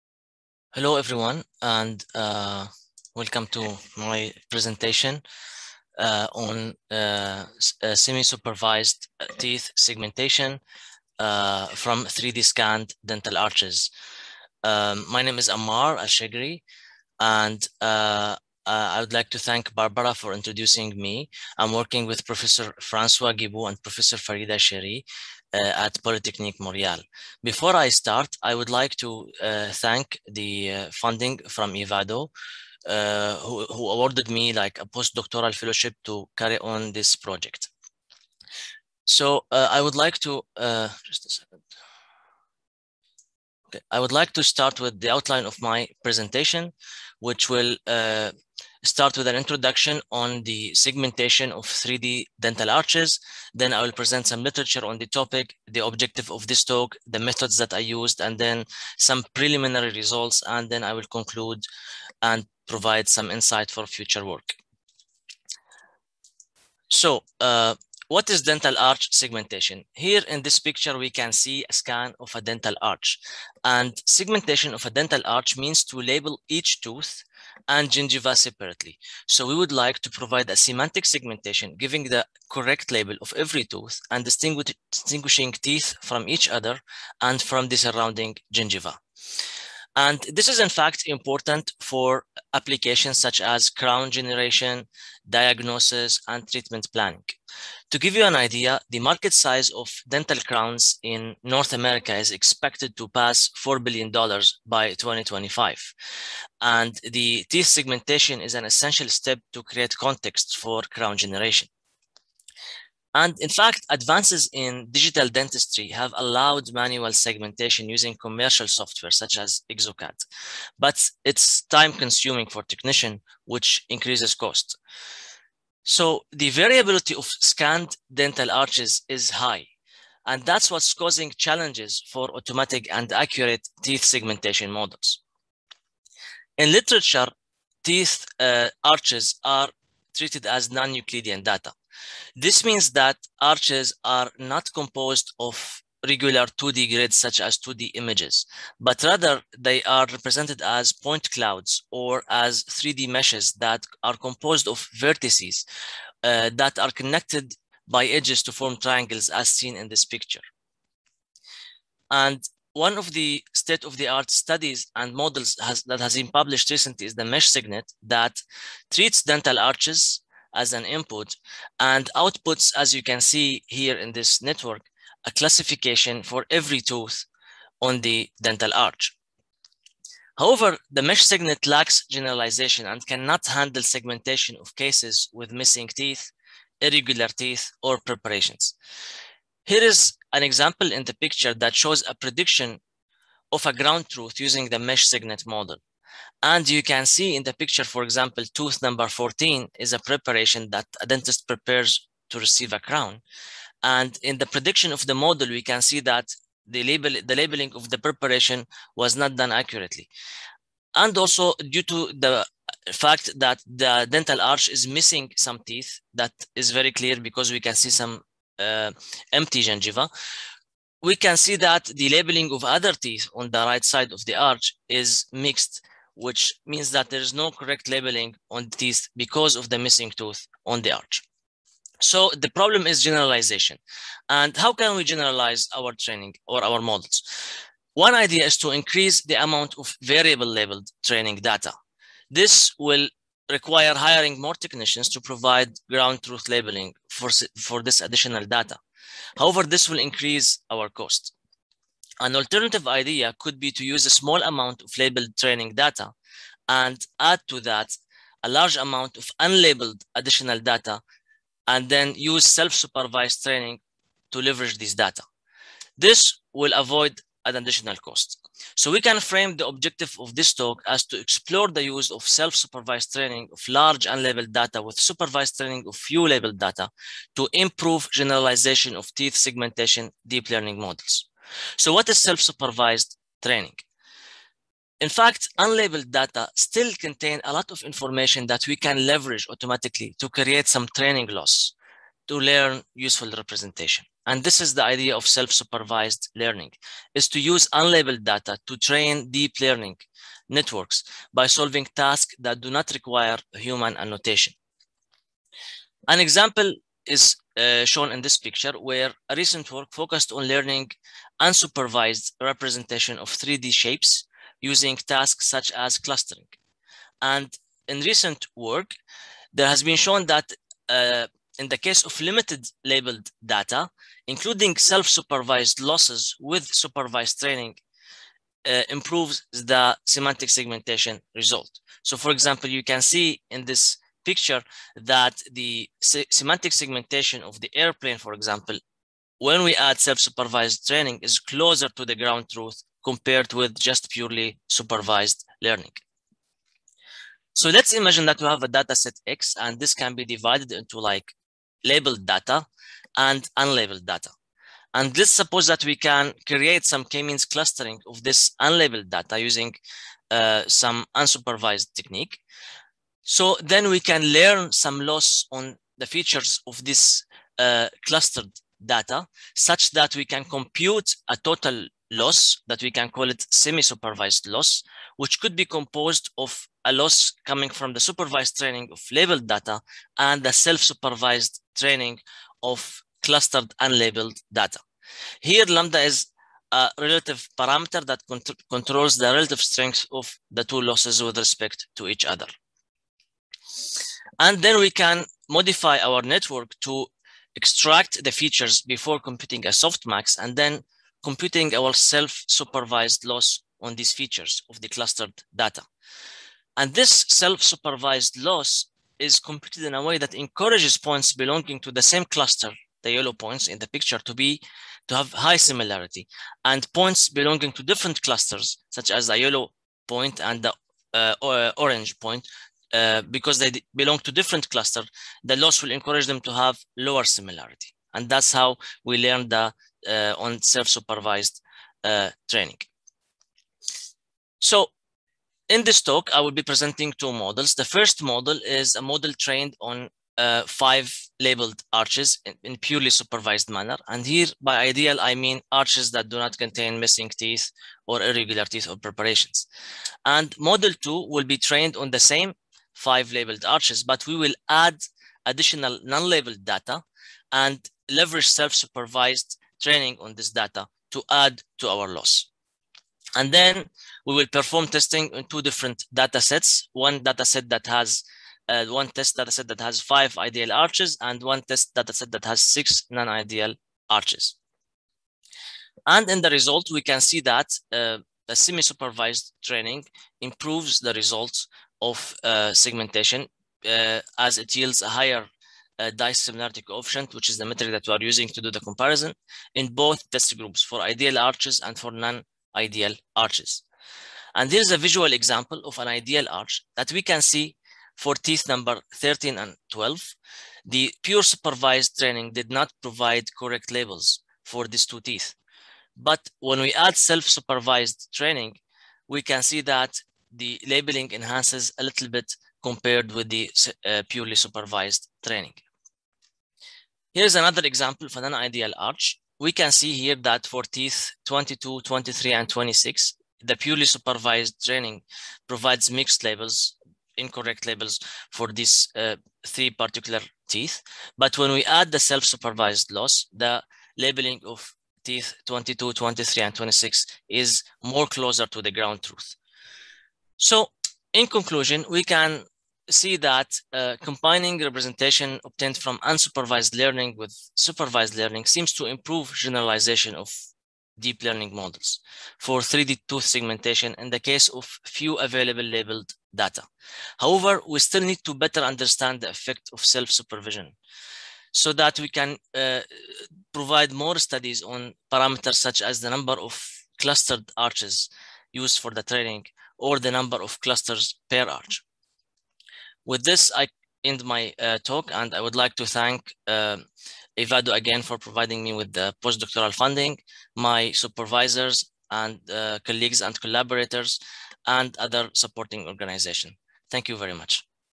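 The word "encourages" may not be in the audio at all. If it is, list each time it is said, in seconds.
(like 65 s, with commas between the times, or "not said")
410 s, 425 s.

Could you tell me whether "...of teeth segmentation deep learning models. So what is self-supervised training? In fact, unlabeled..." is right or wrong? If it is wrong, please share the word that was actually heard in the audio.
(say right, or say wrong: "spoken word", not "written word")
right.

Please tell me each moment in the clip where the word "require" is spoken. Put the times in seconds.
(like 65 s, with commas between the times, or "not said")
243 s, 302 s.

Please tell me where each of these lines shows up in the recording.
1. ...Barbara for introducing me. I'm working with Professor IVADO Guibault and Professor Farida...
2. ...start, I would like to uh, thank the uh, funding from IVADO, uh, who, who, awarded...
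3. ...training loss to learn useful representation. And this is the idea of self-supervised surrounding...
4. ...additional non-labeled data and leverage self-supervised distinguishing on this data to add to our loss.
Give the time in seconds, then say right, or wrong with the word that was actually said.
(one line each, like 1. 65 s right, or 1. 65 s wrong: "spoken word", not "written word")
1. 19 s wrong: "Francois", not "IVADO"
2. 27 s right
3. 290 s wrong: "learning", not "surrounding"
4. 455 s wrong: "training", not "distinguishing".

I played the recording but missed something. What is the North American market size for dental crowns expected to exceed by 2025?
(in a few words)
$4 billion.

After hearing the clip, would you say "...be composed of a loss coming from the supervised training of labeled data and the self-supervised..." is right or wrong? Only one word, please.
right.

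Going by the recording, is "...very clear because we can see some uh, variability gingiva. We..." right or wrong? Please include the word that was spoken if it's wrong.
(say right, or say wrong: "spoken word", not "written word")
wrong: "empty", not "variability".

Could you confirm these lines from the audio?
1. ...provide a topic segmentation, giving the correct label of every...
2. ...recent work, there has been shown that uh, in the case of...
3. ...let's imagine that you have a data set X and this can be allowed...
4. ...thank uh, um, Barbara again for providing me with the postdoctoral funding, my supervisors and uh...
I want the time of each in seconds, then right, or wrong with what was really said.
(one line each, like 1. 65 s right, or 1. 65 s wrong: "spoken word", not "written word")
1. 80 s wrong: "semantic", not "topic"
2. 318 s right
3. 347 s wrong: "divided", not "allowed"
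4. 576 s wrong: "IVADO", not "Barbara".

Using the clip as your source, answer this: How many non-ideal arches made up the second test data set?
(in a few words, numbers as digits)
6.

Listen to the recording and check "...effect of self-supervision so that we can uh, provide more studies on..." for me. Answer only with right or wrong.
right.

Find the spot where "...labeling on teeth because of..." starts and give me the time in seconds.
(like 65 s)
227 s.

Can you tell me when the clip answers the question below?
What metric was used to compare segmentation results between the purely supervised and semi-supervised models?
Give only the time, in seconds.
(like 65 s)
486 s.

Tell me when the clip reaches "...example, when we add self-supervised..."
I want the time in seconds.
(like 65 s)
338 s.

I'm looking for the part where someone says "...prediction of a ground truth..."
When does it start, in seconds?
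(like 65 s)
192 s.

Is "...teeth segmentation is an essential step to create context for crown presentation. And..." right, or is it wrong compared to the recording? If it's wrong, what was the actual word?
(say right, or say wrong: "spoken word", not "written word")
wrong: "generation", not "presentation".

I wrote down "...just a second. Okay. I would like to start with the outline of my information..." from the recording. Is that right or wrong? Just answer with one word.
wrong.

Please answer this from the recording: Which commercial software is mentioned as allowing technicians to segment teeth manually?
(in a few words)
Exocad.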